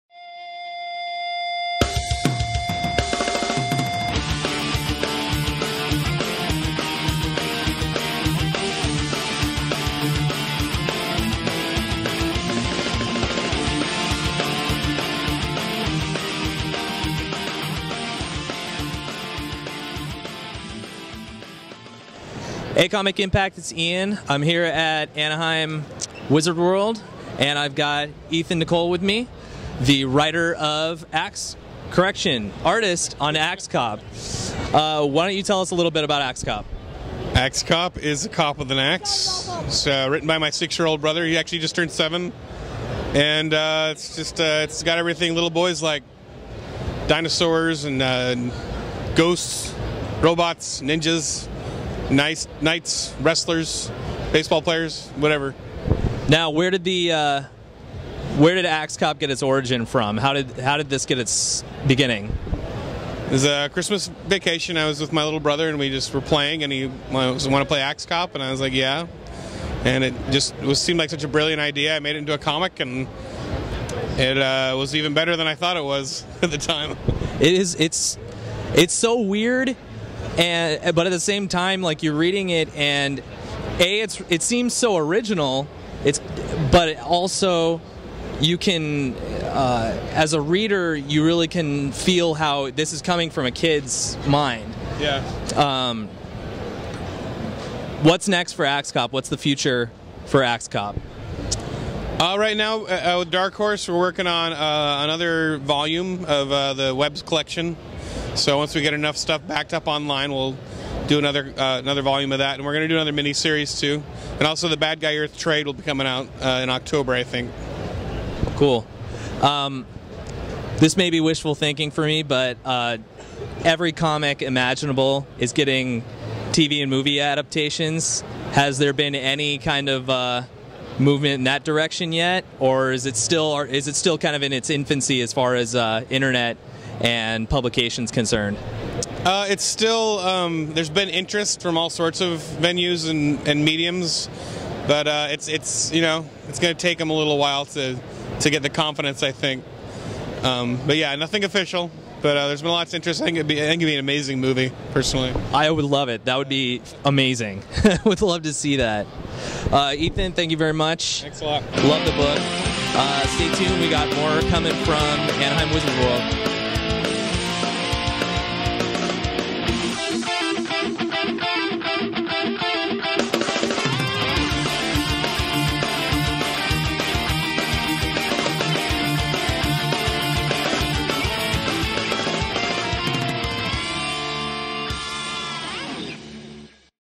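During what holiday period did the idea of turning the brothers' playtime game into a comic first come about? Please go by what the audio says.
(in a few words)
Christmas vacation.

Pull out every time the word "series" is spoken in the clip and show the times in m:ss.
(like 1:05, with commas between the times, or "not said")
1:53.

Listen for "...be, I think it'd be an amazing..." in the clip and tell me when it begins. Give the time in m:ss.
2:33.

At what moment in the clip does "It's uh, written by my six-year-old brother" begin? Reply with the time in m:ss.
0:39.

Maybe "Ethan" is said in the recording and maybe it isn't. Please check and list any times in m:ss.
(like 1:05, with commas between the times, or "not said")
0:28, 2:39.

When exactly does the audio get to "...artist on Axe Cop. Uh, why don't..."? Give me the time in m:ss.
0:32.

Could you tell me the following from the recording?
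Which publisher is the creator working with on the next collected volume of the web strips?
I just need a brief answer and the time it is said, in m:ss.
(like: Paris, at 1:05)
Dark Horse, at 1:43.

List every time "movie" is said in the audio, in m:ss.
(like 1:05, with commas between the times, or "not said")
2:06, 2:34.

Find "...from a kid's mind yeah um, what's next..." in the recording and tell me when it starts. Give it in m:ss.
1:33.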